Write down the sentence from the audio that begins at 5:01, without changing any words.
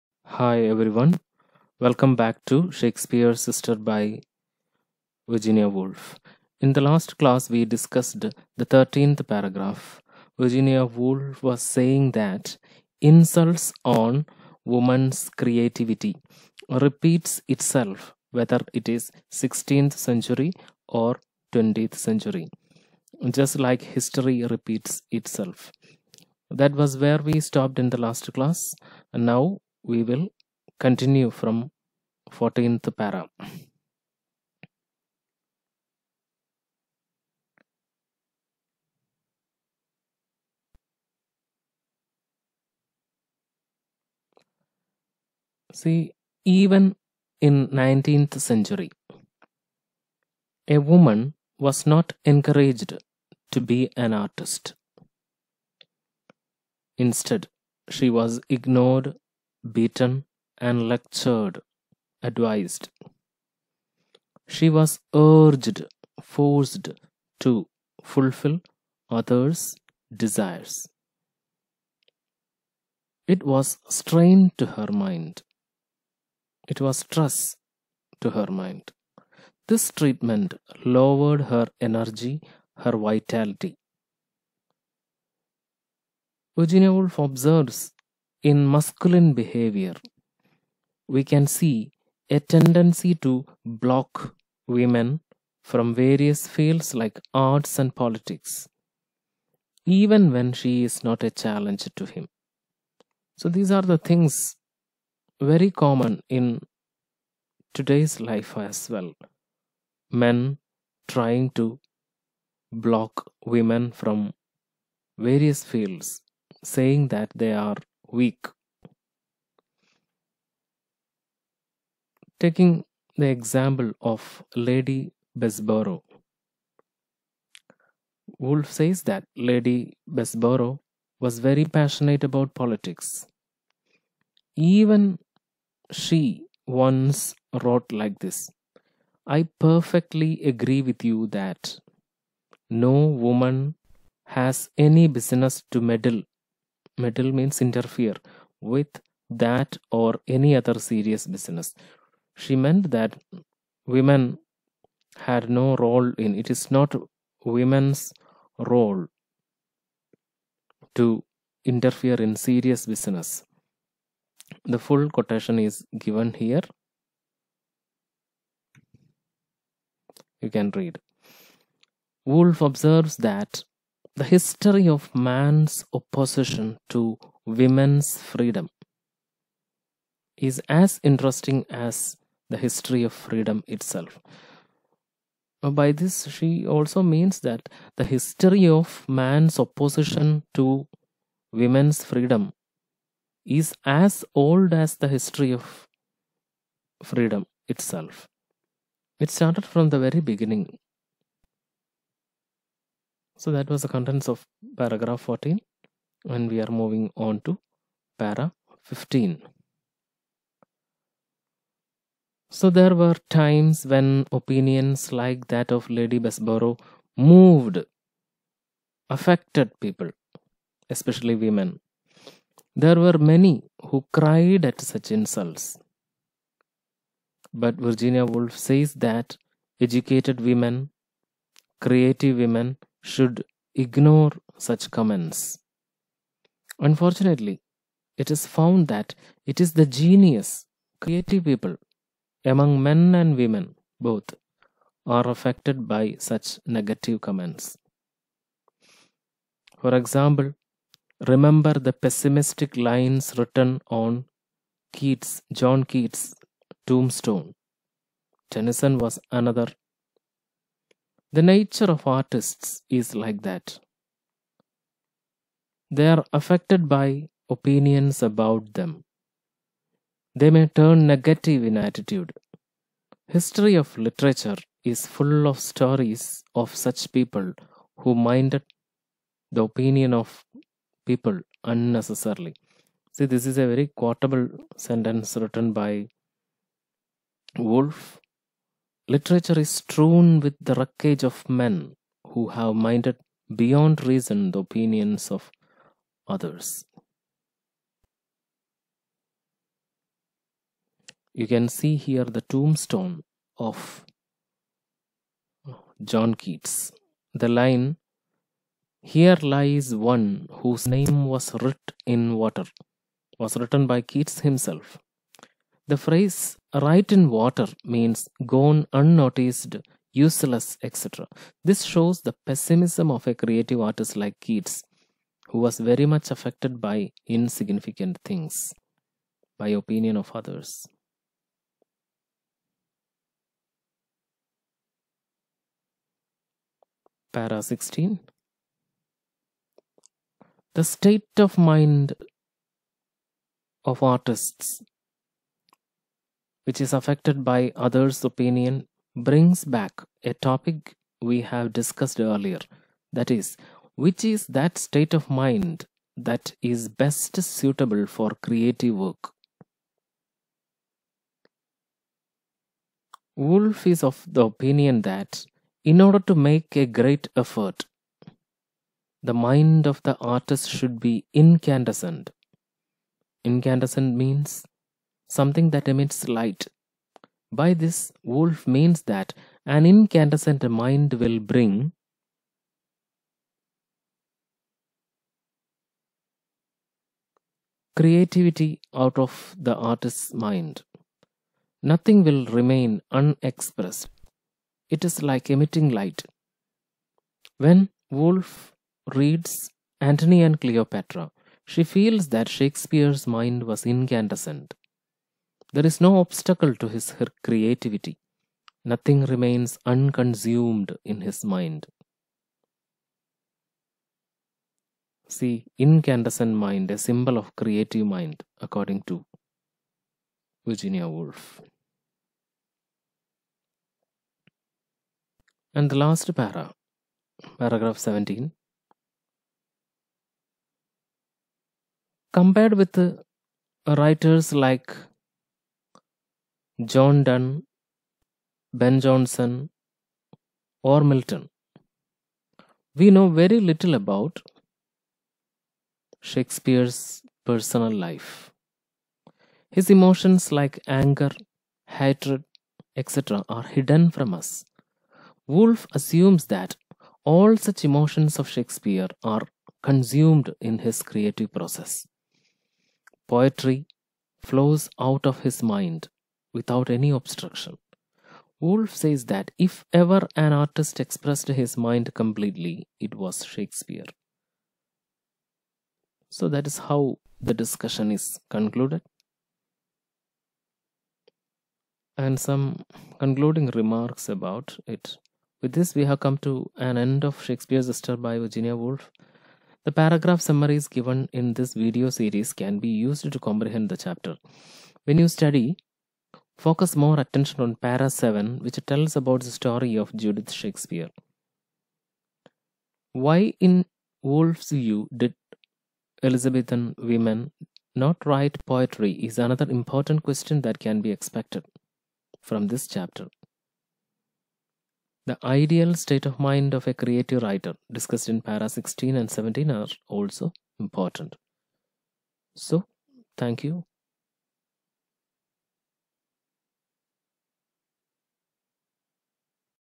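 You can see here the tombstone of John Keats.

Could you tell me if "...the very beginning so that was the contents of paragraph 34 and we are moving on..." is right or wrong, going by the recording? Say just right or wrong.
wrong.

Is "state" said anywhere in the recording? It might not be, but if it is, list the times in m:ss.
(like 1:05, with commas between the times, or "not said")
5:40, 5:54, 8:35.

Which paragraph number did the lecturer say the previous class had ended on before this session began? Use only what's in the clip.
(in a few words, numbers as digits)
13th.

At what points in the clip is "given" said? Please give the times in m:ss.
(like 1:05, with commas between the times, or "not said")
2:45, 8:10.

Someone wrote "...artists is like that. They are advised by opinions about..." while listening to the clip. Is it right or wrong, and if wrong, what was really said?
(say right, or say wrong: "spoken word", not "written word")
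wrong: "affected", not "advised".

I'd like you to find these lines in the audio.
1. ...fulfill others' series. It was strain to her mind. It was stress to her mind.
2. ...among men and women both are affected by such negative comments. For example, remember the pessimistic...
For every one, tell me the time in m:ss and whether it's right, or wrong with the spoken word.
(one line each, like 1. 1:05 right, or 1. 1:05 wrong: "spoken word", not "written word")
1. 1:08 wrong: "desires", not "series"
2. 4:02 right.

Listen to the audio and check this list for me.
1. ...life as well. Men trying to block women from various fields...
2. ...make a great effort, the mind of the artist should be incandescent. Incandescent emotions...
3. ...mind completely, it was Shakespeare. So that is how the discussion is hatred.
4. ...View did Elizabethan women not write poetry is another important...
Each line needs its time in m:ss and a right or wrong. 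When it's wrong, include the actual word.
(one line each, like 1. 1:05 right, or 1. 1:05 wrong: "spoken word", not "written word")
1. 1:48 right
2. 6:06 wrong: "means", not "emotions"
3. 7:51 wrong: "concluded", not "hatred"
4. 8:24 right.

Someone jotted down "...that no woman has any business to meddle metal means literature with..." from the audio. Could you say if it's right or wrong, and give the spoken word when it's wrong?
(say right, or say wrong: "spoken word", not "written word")
wrong: "interfere", not "literature".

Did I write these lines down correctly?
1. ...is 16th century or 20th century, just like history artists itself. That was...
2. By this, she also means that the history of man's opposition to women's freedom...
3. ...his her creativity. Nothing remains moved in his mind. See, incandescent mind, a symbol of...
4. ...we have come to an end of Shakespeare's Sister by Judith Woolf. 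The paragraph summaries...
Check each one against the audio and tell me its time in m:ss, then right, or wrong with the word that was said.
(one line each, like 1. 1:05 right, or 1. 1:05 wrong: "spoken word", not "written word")
1. 0:18 wrong: "repeats", not "artists"
2. 3:05 right
3. 6:46 wrong: "unconsumed", not "moved"
4. 8:05 wrong: "Virginia", not "Judith".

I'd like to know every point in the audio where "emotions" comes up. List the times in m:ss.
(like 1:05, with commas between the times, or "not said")
7:29, 7:37.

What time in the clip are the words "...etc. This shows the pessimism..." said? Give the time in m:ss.
5:20.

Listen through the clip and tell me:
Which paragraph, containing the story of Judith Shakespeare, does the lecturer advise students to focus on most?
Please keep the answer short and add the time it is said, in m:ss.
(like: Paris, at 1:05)
Paragraph 7, at 8:17.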